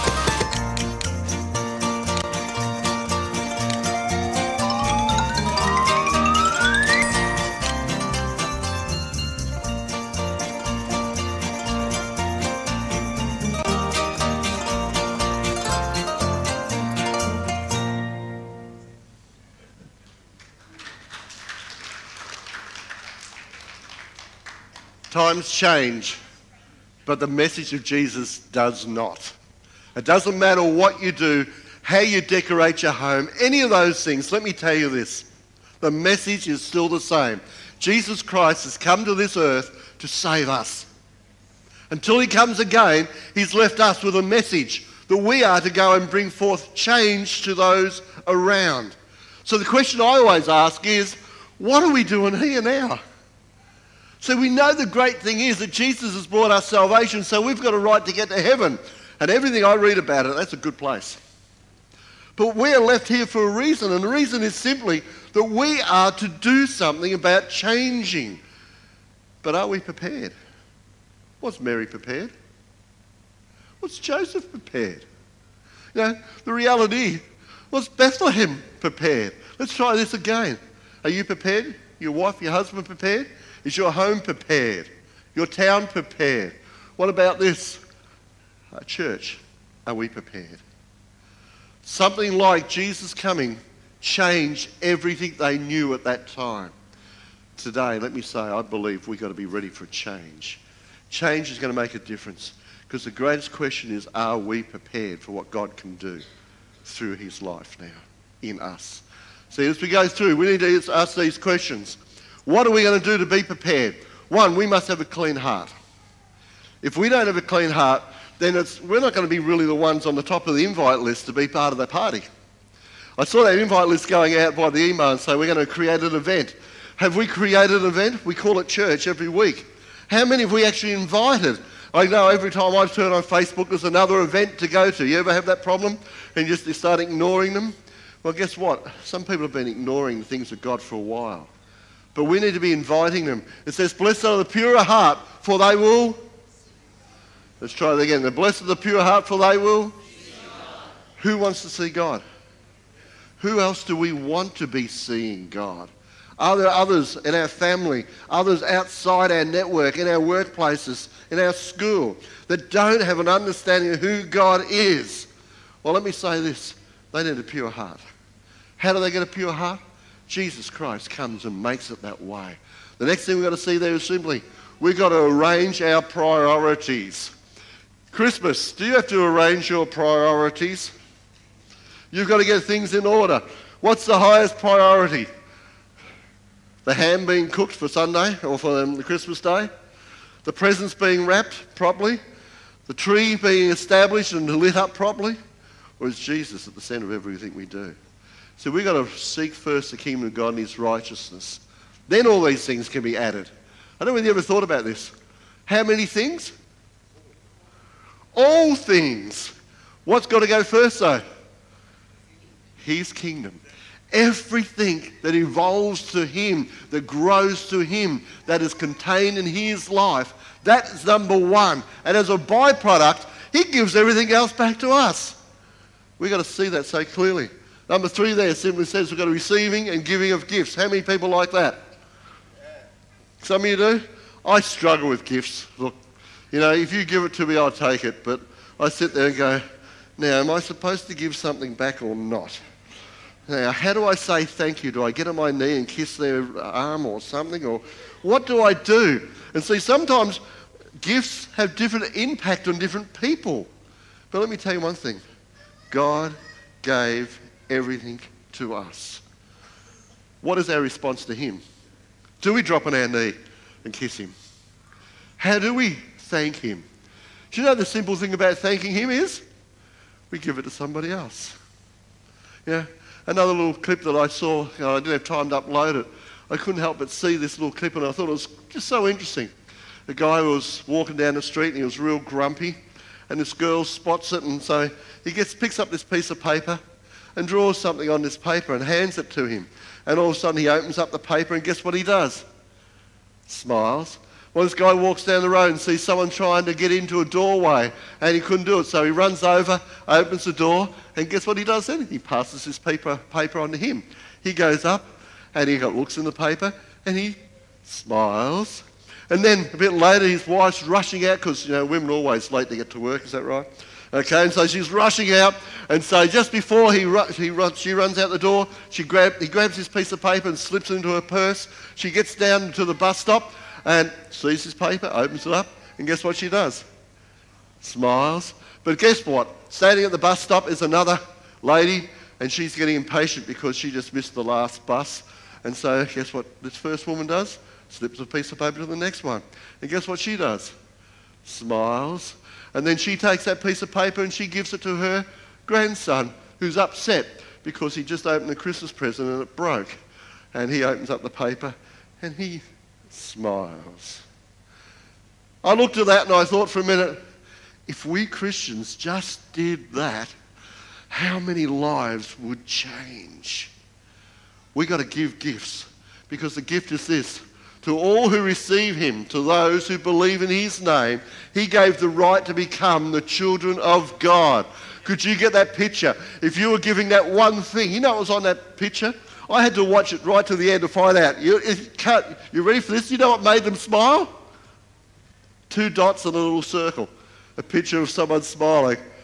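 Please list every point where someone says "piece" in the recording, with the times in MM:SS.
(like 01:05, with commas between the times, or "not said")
04:46, 05:19, 05:38, 05:43.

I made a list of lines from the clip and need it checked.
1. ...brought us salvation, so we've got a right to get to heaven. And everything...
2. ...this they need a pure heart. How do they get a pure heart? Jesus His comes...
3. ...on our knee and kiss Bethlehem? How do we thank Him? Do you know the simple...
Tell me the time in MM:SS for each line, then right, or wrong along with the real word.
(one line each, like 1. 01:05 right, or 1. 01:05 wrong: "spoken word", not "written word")
1. 00:56 right
2. 02:46 wrong: "Christ", not "His"
3. 04:22 wrong: "Him", not "Bethlehem".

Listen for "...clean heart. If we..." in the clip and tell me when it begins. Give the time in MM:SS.
01:55.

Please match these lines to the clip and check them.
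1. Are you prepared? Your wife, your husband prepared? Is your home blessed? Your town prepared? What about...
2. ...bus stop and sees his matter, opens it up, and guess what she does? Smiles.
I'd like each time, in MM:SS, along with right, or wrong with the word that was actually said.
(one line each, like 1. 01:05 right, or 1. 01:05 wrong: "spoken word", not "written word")
1. 01:21 wrong: "prepared", not "blessed"
2. 05:22 wrong: "paper", not "matter".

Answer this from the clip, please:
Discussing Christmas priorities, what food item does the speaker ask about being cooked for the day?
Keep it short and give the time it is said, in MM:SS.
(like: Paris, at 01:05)
Ham, at 03:06.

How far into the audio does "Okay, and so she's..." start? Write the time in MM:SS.
05:14.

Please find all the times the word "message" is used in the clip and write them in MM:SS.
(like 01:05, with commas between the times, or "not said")
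00:27, 00:35, 00:44.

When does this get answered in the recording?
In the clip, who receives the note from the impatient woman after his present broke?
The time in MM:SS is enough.
05:45.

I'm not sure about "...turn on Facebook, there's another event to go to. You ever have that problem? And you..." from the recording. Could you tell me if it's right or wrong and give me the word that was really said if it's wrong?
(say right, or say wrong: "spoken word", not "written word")
right.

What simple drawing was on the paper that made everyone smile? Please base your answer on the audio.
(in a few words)
Two dots and a little circle.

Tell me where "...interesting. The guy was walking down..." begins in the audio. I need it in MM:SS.
04:39.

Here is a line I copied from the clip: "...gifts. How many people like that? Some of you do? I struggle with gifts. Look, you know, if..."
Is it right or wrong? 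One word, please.
right.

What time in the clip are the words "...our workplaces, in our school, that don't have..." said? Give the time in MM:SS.
02:40.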